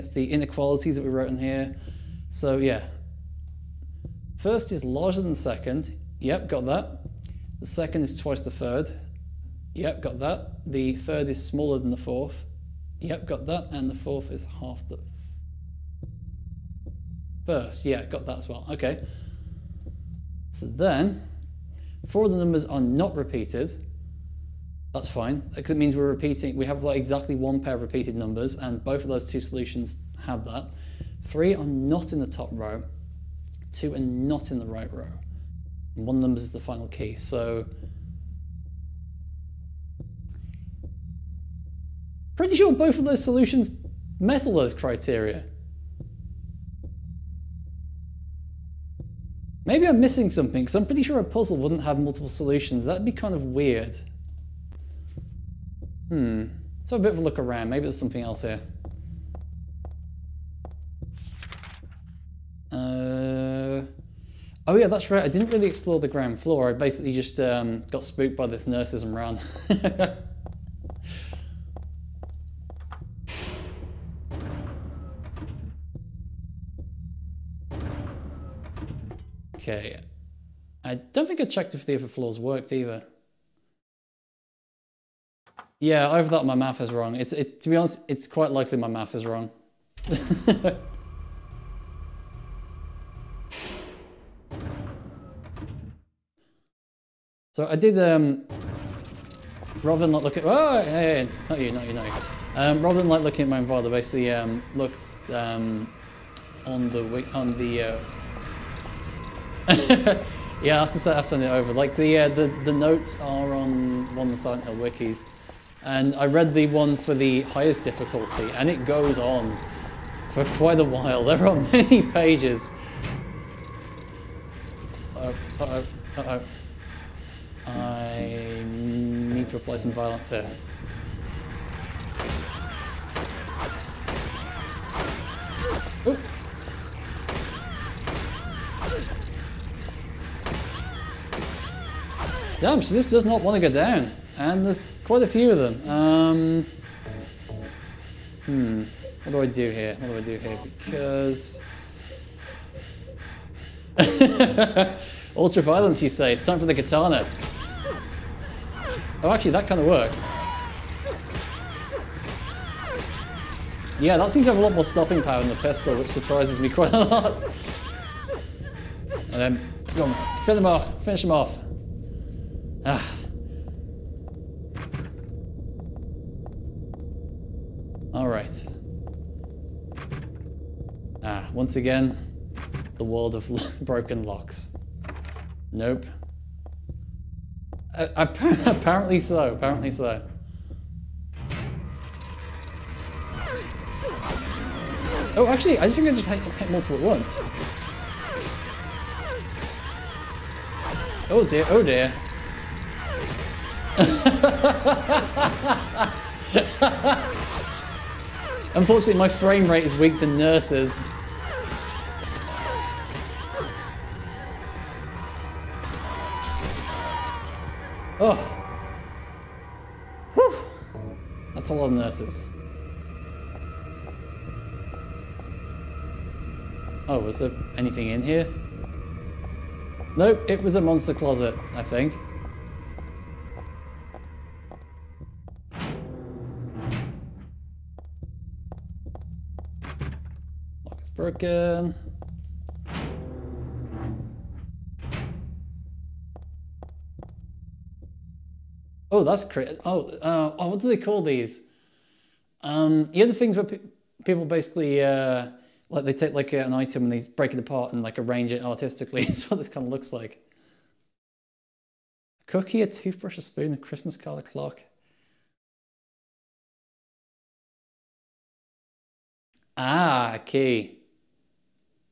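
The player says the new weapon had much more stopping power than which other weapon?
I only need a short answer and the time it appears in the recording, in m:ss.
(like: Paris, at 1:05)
The pistol, at 2:45.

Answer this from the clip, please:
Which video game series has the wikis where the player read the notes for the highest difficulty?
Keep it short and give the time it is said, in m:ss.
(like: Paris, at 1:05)
Silent Hill, at 1:54.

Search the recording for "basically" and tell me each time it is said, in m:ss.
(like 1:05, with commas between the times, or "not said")
1:06, 1:43, 4:14.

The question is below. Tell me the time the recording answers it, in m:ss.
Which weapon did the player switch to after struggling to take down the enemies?
2:36.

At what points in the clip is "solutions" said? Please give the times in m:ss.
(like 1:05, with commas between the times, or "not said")
0:29, 0:43, 0:52.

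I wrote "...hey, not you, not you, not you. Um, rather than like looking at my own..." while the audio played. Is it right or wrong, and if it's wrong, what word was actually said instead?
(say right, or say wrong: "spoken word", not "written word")
right.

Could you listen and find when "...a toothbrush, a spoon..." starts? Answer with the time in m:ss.
4:22.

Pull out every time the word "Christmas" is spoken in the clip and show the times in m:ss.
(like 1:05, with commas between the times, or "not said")
4:23.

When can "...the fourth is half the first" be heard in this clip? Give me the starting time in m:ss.
0:13.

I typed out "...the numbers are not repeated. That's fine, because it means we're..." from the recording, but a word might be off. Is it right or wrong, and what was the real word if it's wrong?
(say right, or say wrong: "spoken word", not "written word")
right.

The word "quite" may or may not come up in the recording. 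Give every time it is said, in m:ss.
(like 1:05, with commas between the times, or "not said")
1:28, 2:00, 2:25, 2:46.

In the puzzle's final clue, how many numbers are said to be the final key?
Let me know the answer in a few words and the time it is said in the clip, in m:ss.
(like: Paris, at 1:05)
1, at 0:36.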